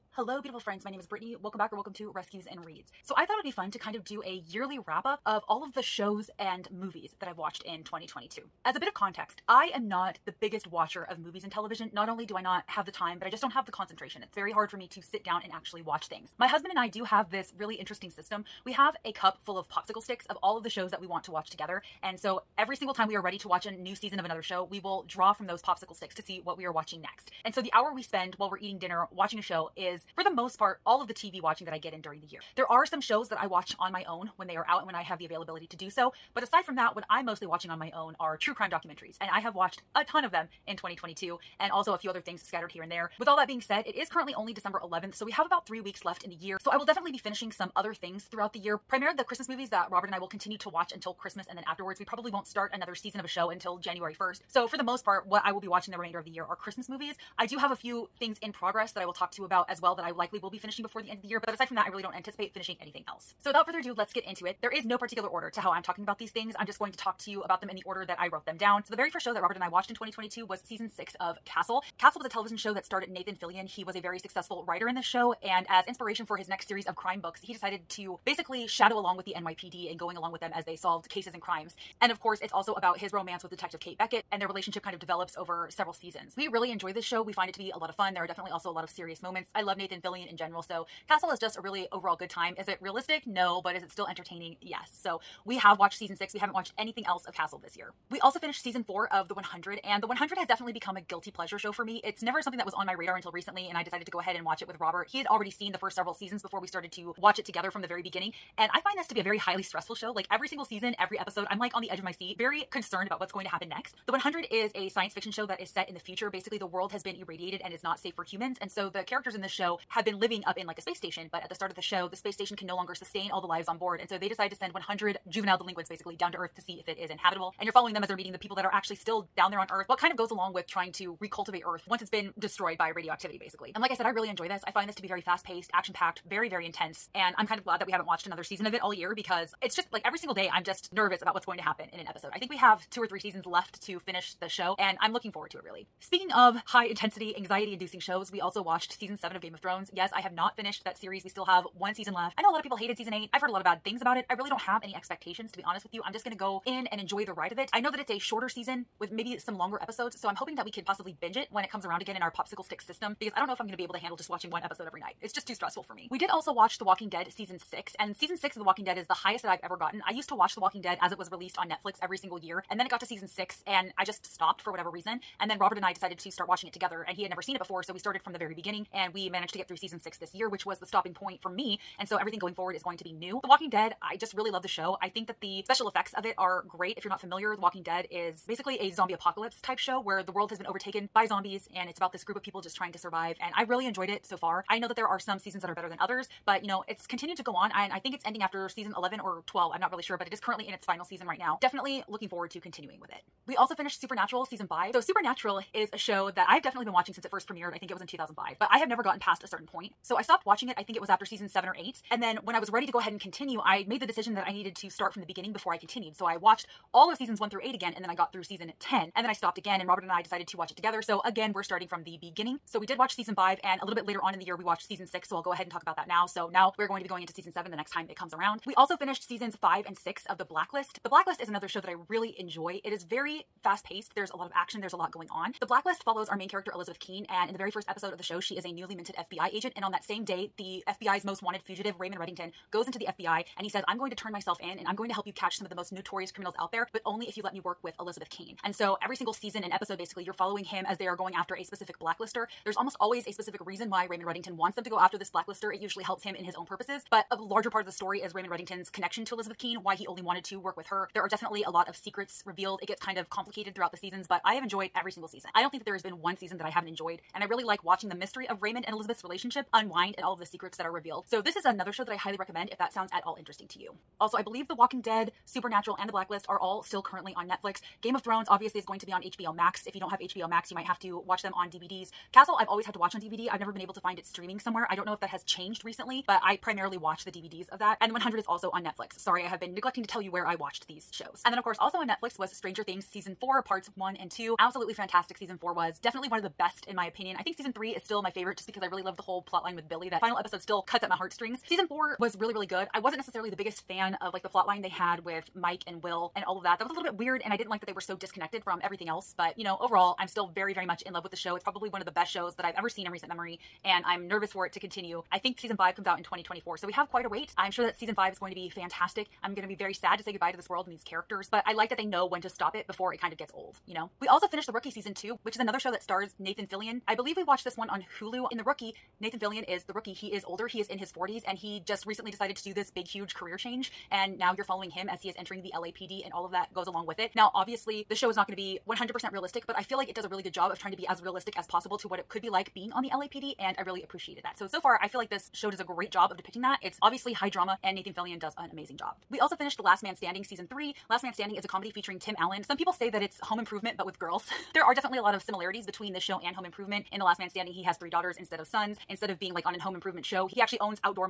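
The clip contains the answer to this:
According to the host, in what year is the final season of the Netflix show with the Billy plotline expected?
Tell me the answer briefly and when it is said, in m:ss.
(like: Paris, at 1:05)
2024, at 5:16.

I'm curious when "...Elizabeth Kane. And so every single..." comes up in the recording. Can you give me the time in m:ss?
4:07.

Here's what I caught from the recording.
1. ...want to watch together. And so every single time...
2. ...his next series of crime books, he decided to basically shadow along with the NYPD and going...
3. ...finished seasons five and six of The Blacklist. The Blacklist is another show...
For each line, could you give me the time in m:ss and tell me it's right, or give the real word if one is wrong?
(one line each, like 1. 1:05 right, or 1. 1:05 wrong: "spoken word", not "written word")
1. 0:21 right
2. 1:16 right
3. 3:48 right.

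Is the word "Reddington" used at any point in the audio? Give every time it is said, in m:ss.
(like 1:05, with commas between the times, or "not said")
4:02, 4:14, 4:18.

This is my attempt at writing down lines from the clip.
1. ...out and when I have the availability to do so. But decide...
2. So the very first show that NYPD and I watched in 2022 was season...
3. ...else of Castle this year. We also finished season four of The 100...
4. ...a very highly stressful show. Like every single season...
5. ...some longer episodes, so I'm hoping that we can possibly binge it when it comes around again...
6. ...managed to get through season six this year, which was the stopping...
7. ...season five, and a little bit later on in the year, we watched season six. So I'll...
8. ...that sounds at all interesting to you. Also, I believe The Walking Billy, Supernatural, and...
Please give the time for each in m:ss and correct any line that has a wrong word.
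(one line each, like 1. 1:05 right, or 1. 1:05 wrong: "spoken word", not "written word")
1. 0:34 wrong: "aside", not "decide"
2. 1:08 wrong: "Robert", not "NYPD"
3. 1:37 right
4. 1:49 right
5. 2:39 right
6. 2:59 right
7. 3:43 right
8. 4:32 wrong: "Dead", not "Billy".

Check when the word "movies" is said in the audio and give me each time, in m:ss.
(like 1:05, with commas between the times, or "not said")
0:06, 0:11, 0:49, 0:56.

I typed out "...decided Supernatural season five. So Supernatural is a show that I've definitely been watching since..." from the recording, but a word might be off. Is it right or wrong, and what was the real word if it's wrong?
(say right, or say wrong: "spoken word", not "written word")
wrong: "finished", not "decided".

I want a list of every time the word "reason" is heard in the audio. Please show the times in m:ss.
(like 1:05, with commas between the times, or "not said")
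2:54, 4:13.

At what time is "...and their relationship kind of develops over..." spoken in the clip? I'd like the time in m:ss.
1:24.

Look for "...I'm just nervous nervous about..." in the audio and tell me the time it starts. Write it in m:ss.
2:20.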